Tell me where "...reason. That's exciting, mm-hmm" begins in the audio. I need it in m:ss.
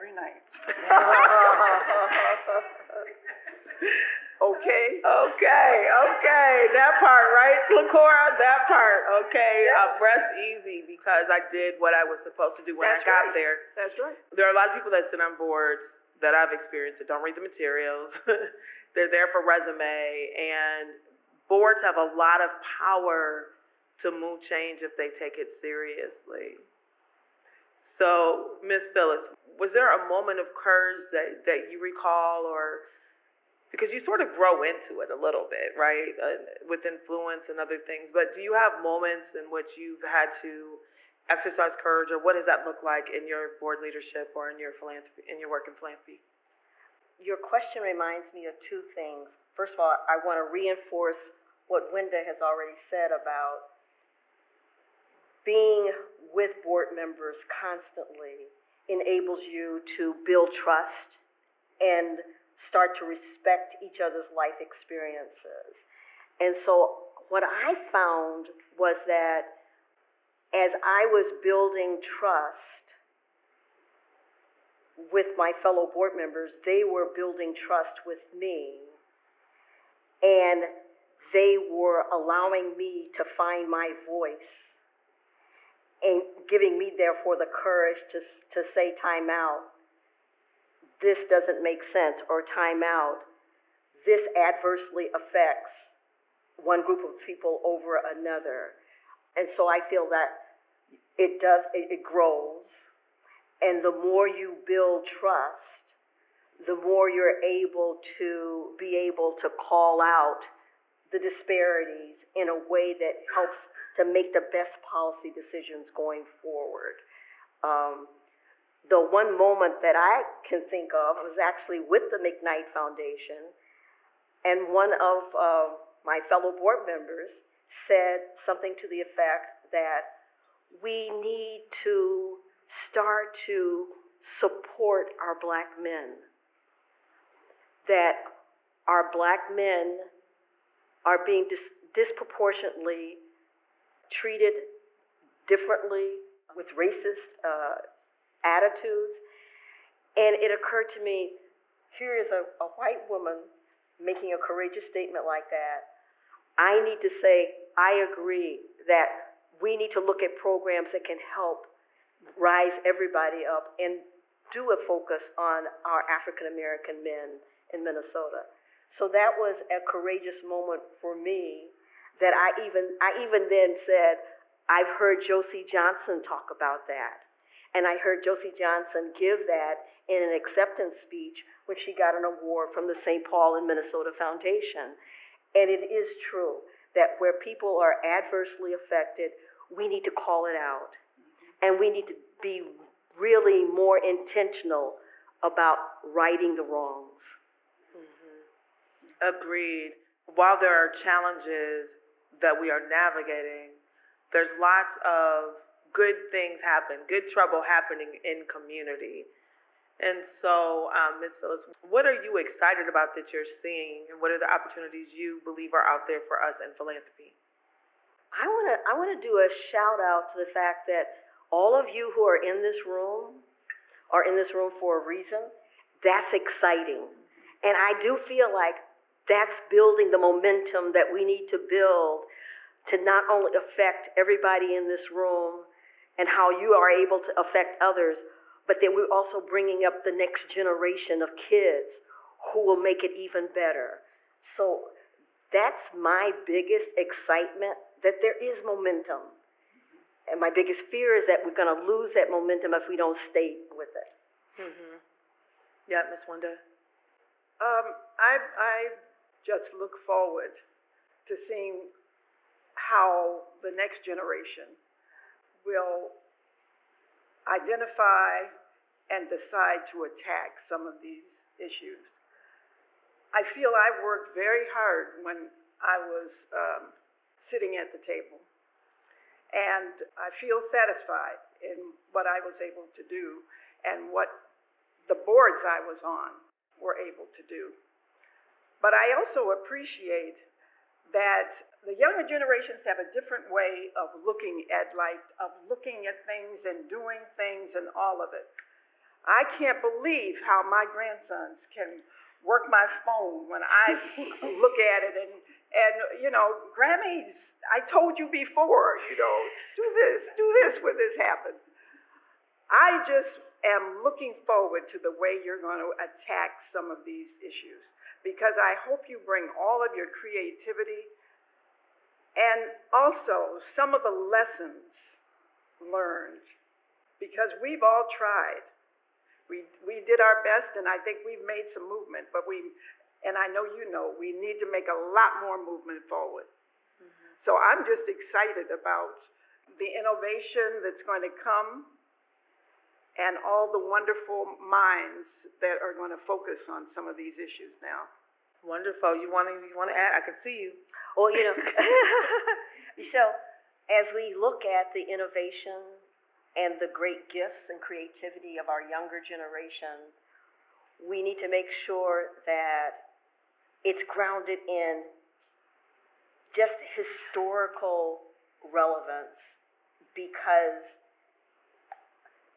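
3:44.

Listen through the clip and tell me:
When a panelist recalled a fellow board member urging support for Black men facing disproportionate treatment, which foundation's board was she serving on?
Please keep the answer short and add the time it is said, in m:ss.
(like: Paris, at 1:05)
McKnight Foundation, at 2:02.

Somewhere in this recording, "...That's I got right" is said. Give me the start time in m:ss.
0:12.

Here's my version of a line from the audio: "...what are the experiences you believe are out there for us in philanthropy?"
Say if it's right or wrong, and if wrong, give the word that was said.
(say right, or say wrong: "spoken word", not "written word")
wrong: "opportunities", not "experiences".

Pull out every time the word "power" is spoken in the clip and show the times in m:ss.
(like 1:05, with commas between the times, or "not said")
0:22.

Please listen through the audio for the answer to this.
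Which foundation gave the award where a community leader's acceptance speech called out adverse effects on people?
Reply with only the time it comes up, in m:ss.
3:02.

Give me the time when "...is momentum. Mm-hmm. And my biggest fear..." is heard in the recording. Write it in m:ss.
4:08.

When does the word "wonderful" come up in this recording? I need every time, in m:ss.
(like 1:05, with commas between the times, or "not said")
5:43, 5:48.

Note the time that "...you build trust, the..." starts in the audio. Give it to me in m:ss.
1:44.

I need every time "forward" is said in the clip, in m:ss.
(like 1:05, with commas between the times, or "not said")
1:56, 4:19, 5:14, 5:36.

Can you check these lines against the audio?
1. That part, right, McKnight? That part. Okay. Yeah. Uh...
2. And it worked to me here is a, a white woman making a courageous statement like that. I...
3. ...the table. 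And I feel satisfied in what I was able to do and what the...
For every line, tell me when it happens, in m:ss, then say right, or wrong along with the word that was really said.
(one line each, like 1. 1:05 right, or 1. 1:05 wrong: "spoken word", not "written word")
1. 0:06 wrong: "LaCora", not "McKnight"
2. 2:30 wrong: "occurred", not "worked"
3. 4:37 right.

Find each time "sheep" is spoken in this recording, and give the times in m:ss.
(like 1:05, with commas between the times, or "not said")
not said.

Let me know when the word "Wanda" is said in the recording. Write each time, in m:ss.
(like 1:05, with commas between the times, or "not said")
4:16.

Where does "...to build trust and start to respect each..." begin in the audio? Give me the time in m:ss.
0:59.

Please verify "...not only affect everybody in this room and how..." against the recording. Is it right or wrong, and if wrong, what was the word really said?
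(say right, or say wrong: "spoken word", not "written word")
right.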